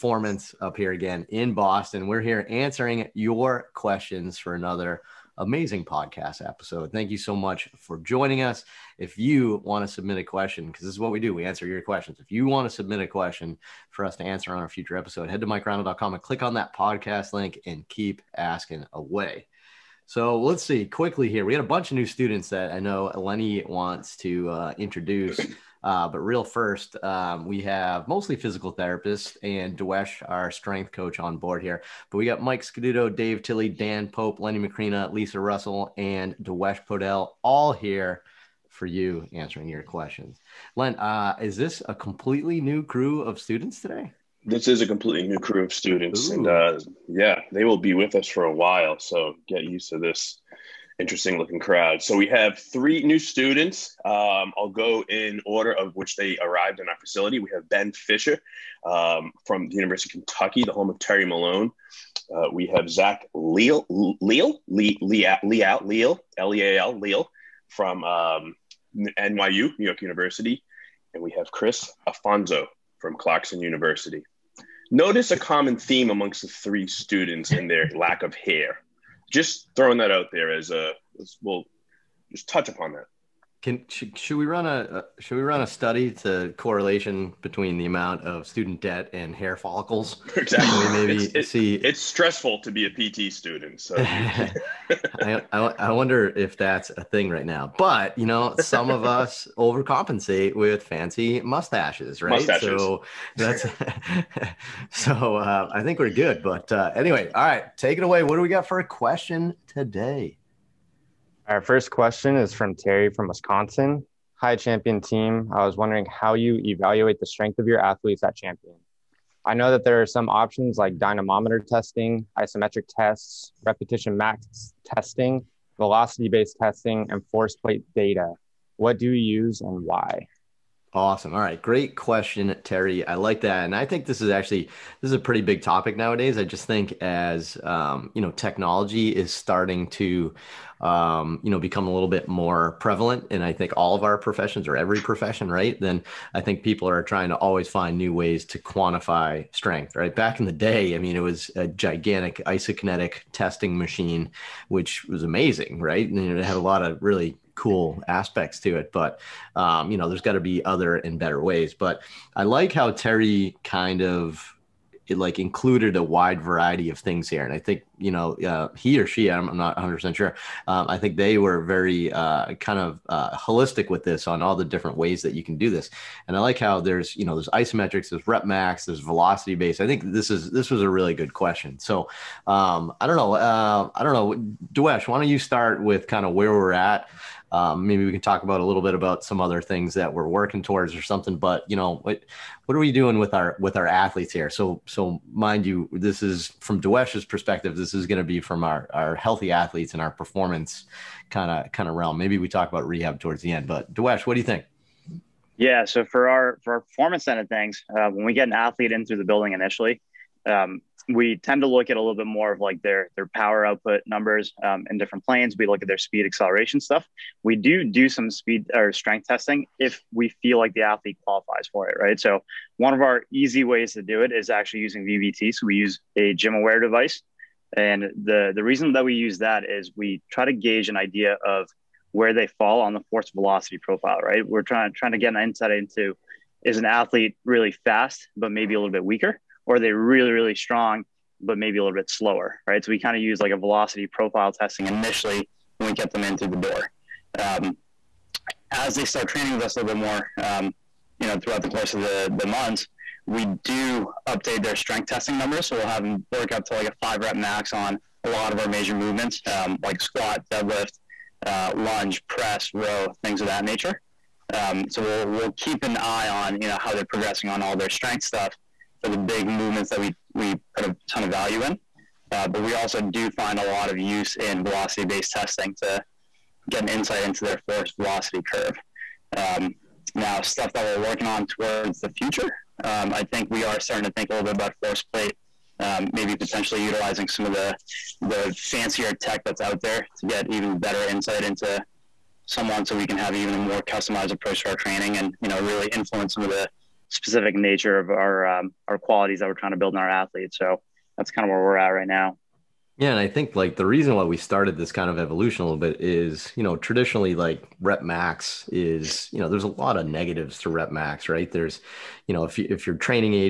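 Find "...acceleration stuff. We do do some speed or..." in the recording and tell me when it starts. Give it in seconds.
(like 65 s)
216 s.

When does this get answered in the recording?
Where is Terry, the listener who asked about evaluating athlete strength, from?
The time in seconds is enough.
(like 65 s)
113 s.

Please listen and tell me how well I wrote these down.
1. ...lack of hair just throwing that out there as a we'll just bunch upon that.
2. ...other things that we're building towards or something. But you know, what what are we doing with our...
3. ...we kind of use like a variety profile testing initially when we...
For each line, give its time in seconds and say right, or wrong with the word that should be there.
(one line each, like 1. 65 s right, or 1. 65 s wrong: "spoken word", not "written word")
1. 77 s wrong: "touch", not "bunch"
2. 189 s wrong: "working", not "building"
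3. 242 s wrong: "velocity", not "variety".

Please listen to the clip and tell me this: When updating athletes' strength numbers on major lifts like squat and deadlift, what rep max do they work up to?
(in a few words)
5 rep max.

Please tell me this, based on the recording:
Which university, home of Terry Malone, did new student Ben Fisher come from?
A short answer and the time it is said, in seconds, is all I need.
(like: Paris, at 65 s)
University of Kentucky, at 59 s.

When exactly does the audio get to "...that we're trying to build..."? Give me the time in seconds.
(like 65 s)
299 s.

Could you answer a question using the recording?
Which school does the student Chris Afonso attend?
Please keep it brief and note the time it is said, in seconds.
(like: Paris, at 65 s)
Clarkson University, at 73 s.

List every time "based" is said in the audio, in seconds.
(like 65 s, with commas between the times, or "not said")
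126 s, 179 s, 275 s.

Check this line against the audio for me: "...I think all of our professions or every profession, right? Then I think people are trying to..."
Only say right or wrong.
right.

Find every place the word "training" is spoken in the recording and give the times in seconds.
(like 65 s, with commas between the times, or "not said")
249 s, 294 s, 312 s.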